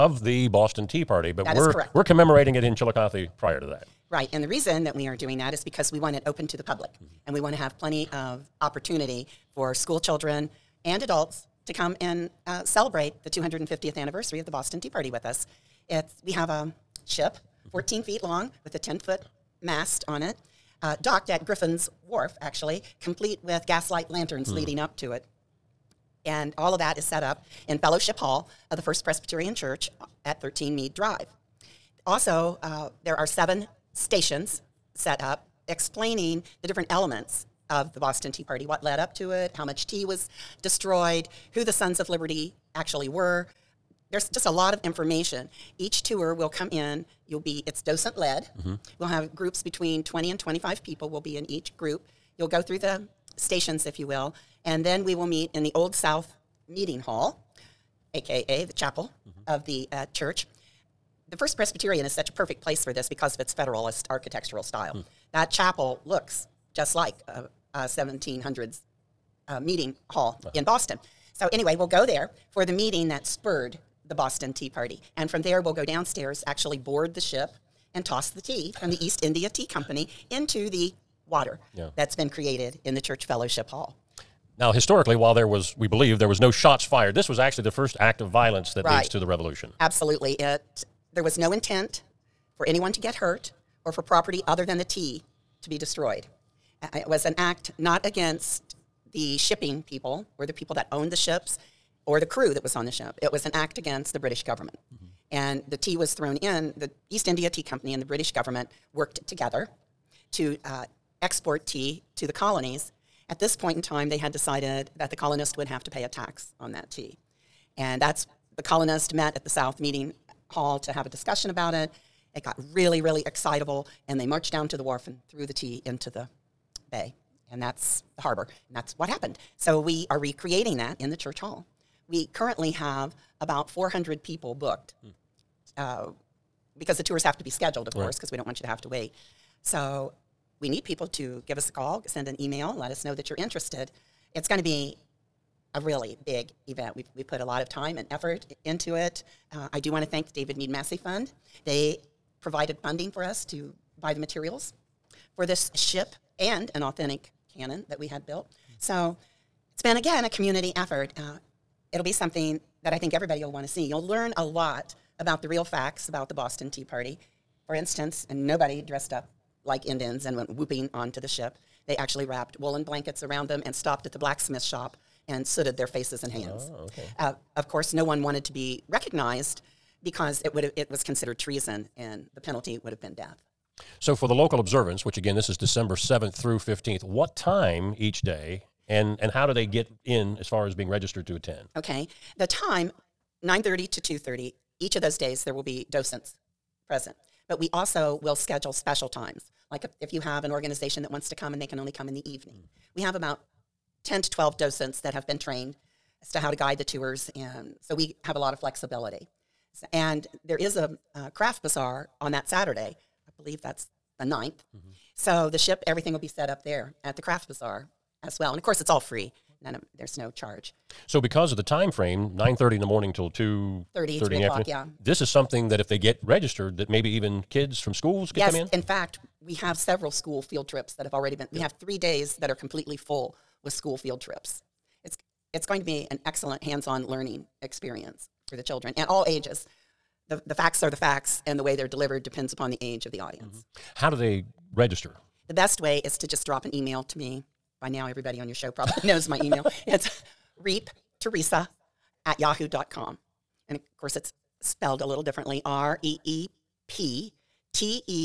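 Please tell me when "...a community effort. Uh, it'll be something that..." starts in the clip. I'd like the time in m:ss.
2:40.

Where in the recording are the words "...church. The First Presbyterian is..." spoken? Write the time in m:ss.
1:00.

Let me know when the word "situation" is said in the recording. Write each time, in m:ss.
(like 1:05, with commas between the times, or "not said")
not said.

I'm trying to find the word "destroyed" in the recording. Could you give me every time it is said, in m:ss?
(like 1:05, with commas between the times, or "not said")
0:40, 1:35.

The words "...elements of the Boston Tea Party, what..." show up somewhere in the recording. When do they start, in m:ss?
0:36.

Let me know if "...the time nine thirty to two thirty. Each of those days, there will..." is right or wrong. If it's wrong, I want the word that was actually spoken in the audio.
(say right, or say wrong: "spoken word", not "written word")
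right.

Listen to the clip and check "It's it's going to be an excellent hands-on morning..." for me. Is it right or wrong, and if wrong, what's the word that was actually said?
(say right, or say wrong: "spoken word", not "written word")
wrong: "learning", not "morning".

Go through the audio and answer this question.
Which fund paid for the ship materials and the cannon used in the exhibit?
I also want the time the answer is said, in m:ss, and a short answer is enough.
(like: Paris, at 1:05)
David Meade Massie Fund, at 2:30.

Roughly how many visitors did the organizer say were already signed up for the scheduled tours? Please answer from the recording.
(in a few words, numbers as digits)
400.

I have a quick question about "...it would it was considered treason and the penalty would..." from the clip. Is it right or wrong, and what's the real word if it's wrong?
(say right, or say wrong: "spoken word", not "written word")
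right.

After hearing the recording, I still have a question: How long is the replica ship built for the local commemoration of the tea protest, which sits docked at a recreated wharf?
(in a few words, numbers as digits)
14 feet.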